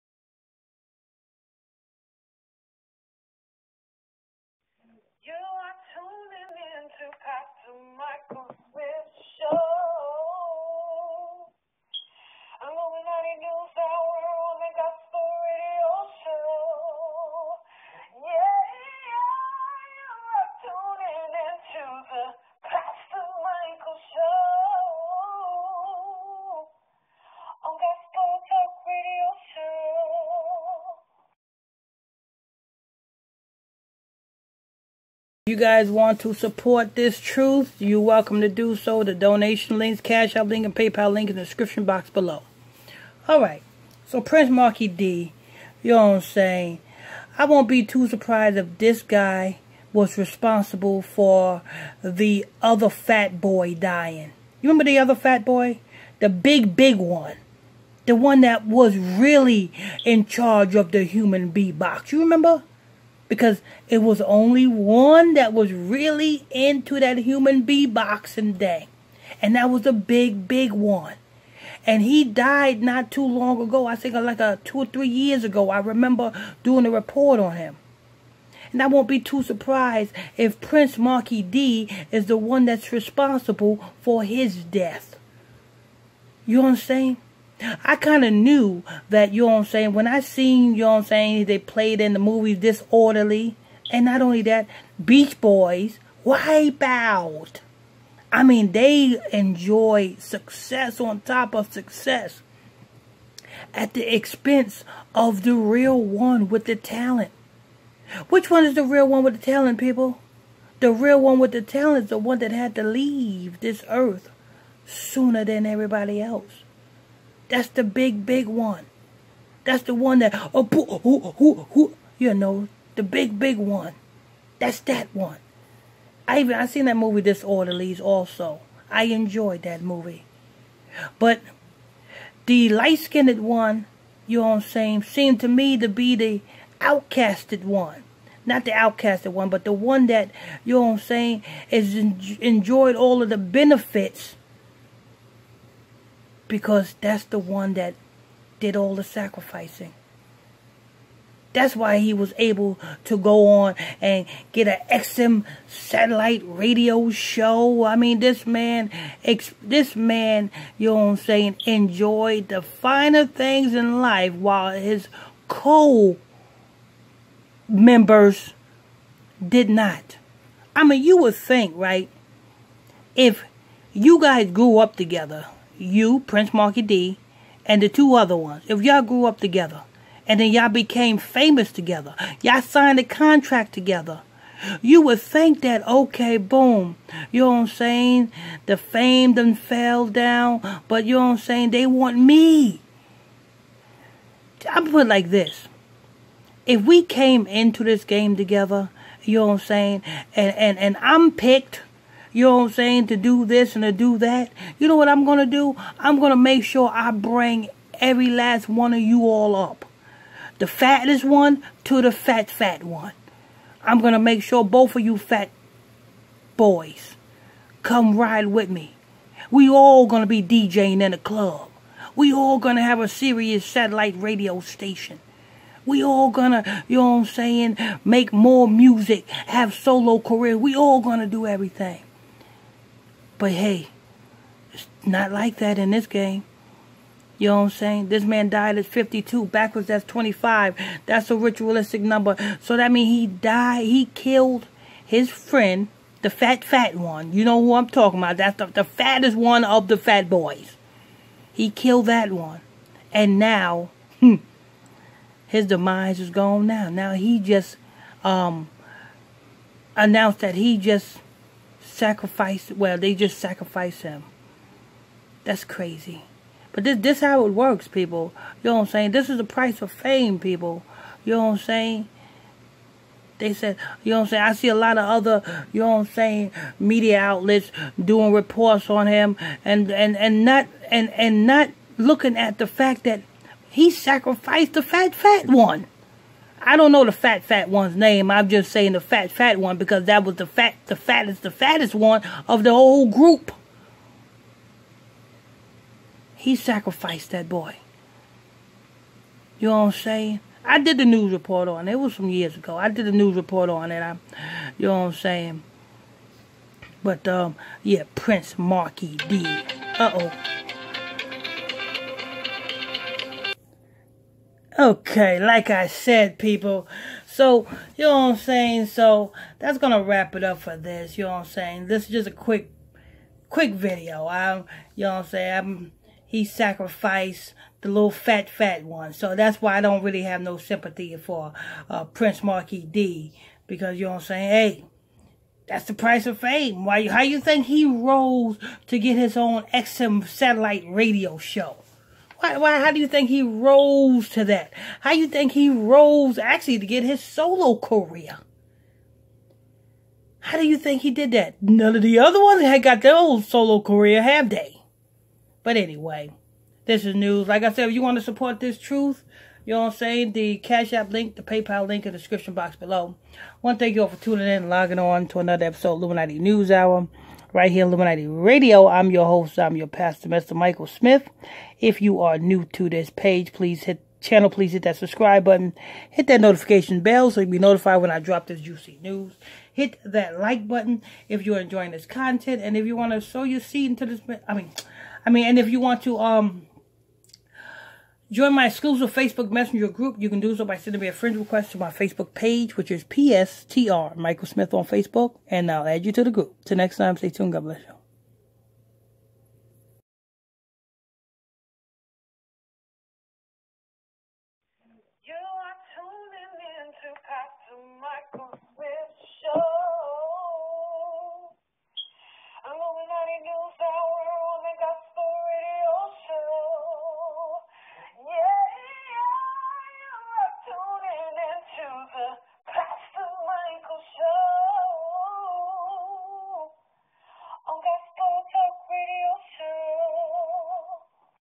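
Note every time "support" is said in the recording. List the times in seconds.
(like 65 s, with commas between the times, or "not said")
36 s, 358 s.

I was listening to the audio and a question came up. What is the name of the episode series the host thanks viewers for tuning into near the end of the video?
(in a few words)
Illuminati News Hour.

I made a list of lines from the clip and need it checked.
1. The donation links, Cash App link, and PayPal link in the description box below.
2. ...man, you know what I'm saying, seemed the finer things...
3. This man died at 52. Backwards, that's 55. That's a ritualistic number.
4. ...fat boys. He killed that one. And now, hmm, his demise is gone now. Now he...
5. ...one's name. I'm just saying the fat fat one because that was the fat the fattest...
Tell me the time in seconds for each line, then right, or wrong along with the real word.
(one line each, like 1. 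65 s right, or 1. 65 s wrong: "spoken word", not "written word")
1. 39 s right
2. 159 s wrong: "enjoyed", not "seemed"
3. 238 s wrong: "25", not "55"
4. 249 s right
5. 287 s right.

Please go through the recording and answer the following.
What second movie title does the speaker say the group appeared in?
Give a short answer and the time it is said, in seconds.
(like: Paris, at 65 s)
Wipe Out, at 96 s.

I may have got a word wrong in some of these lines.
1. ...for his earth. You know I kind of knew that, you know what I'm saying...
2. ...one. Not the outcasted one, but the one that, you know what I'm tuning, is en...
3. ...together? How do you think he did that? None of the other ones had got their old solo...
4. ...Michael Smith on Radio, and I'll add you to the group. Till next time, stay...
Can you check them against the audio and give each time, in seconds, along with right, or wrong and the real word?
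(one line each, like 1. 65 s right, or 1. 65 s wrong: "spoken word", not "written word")
1. 84 s wrong: "death", not "earth"
2. 137 s wrong: "saying", not "tuning"
3. 347 s wrong: "career", not "together"
4. 394 s wrong: "Facebook", not "Radio".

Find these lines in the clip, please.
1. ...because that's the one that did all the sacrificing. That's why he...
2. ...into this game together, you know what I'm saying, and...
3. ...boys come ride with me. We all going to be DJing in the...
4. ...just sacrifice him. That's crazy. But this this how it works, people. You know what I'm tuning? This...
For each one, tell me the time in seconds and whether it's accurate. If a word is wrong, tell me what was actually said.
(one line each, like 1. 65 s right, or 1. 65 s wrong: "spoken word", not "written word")
1. 146 s right
2. 197 s right
3. 216 s right
4. 263 s wrong: "saying", not "tuning".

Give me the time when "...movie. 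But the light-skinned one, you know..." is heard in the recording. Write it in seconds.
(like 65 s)
129 s.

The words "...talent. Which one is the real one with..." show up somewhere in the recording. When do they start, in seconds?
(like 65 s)
106 s.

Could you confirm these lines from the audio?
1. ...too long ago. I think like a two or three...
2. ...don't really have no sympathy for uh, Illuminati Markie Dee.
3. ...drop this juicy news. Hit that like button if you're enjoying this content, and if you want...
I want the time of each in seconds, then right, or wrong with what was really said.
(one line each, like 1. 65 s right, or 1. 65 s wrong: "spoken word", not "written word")
1. 73 s right
2. 329 s wrong: "Prince", not "Illuminati"
3. 378 s right.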